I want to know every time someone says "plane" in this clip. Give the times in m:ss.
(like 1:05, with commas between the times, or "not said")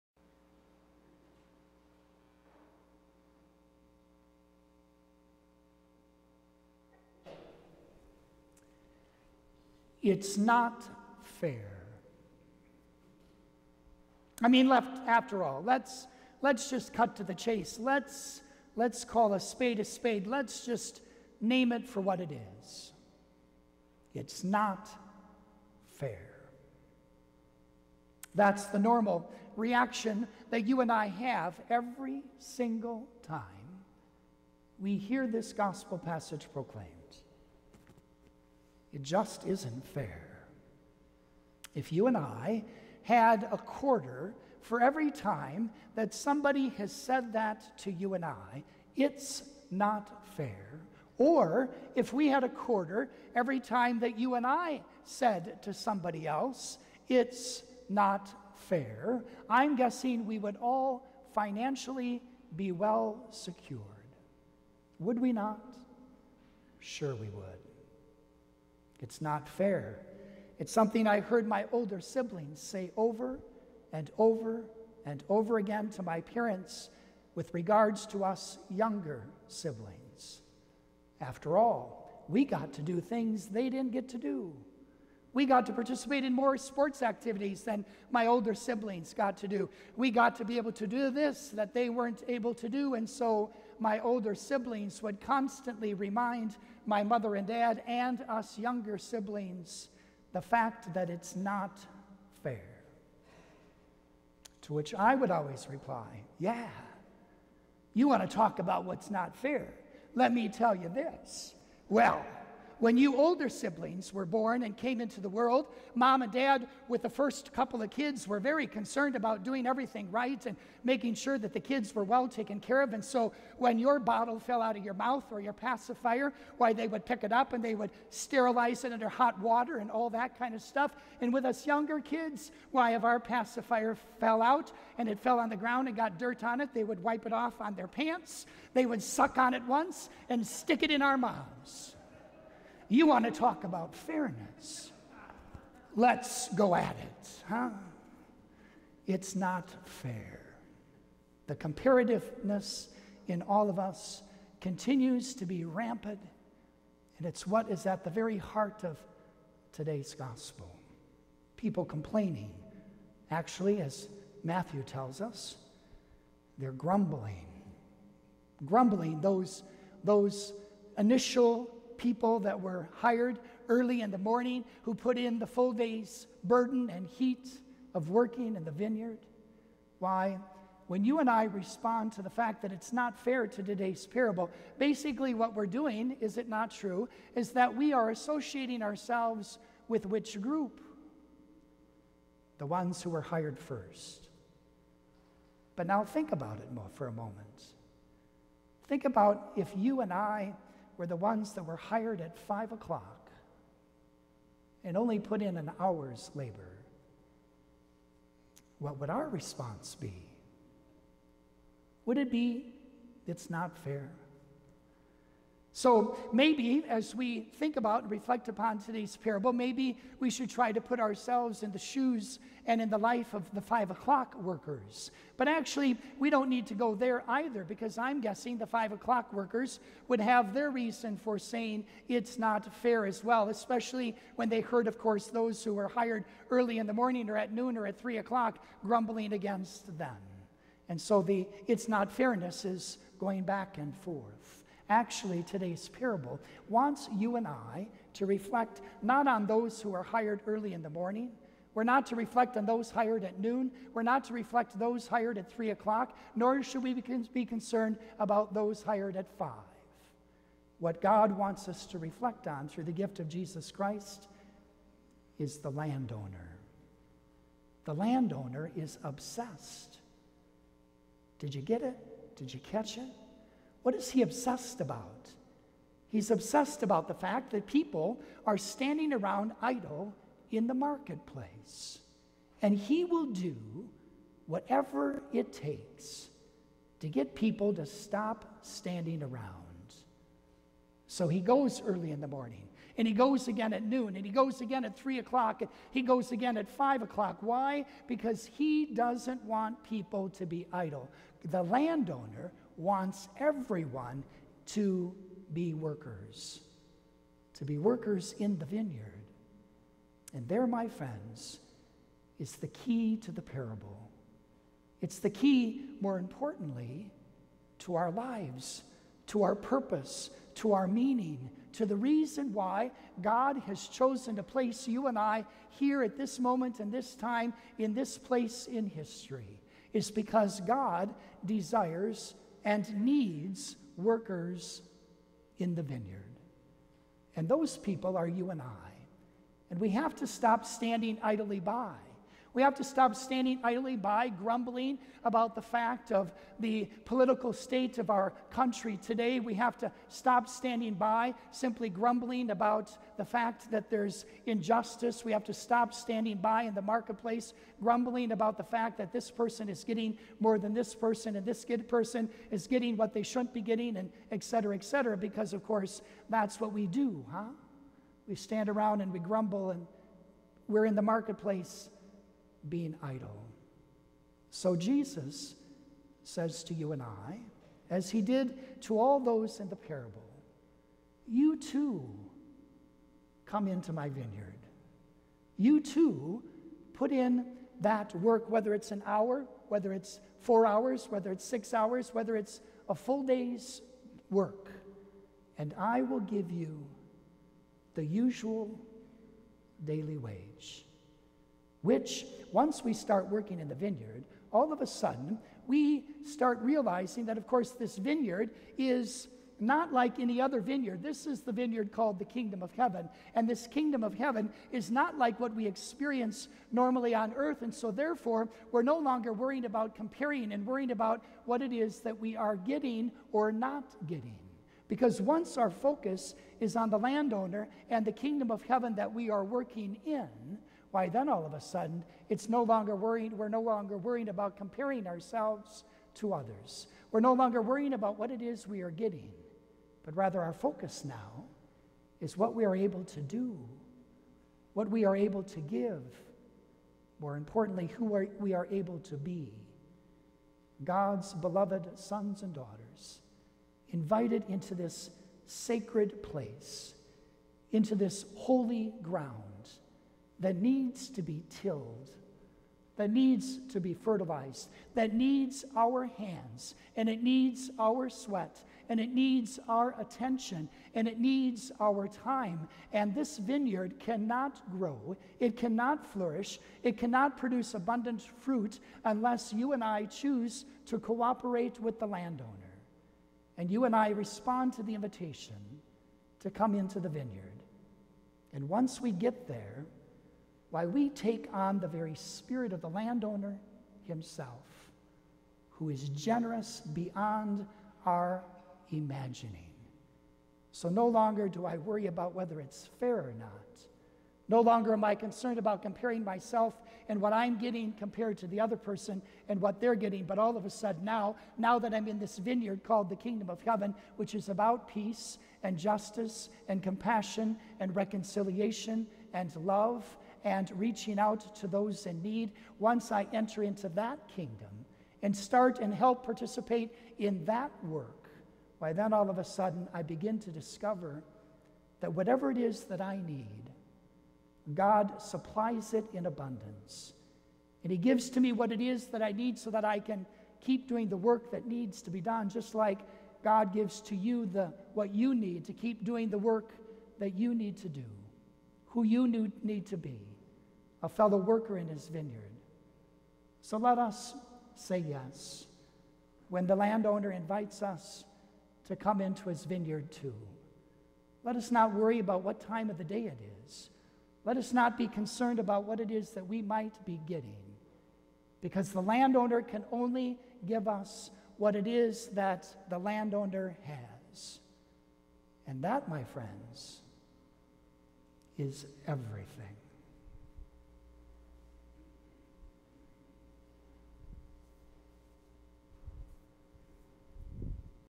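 not said.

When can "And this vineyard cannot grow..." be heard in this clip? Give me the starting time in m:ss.
7:52.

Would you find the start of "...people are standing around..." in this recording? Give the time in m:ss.
4:37.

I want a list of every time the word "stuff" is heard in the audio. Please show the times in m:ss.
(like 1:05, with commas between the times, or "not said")
2:10.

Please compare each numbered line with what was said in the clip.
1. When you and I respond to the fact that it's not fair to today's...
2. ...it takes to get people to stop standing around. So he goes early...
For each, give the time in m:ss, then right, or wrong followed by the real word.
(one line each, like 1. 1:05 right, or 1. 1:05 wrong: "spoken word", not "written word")
1. 3:00 right
2. 4:45 right.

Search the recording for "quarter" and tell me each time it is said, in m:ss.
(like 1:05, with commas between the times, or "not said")
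0:43, 0:52.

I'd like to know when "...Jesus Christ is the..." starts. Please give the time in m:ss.
4:23.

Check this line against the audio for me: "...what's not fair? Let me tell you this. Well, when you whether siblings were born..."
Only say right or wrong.
wrong.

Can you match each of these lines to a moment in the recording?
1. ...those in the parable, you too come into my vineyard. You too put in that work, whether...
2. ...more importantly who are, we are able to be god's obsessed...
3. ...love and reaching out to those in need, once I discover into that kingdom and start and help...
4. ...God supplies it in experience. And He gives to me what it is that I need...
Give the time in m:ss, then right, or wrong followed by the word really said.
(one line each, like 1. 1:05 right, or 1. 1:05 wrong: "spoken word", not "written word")
1. 6:19 right
2. 7:27 wrong: "beloved", not "obsessed"
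3. 8:39 wrong: "enter", not "discover"
4. 8:54 wrong: "abundance", not "experience".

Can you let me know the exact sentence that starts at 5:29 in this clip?
It's because God desires and needs workers in the vineyard.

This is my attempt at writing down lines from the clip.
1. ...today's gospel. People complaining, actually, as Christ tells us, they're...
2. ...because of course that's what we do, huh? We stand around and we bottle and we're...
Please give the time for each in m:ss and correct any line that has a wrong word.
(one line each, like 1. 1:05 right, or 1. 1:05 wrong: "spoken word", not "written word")
1. 2:39 wrong: "Matthew", not "Christ"
2. 6:05 wrong: "grumble", not "bottle".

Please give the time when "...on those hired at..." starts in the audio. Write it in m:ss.
4:12.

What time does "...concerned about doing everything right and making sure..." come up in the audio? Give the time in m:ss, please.
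1:58.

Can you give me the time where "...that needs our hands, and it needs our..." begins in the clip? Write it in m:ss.
7:44.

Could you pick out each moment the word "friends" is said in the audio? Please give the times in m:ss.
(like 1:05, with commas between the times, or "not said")
5:10, 9:36.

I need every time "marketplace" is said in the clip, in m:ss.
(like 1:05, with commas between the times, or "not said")
4:40, 5:56, 6:11.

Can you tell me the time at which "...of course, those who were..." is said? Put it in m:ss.
3:54.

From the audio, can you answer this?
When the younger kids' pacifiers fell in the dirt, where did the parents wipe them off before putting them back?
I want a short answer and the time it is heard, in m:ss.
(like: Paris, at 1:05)
on their pants, at 2:17.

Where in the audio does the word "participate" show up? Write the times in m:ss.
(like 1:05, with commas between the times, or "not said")
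1:25, 8:46.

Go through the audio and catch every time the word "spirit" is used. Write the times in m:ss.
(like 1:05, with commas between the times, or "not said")
8:12.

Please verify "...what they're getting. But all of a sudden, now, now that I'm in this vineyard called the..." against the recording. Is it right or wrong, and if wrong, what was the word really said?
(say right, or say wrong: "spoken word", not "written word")
right.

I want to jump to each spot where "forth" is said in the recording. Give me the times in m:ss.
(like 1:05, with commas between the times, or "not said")
4:03.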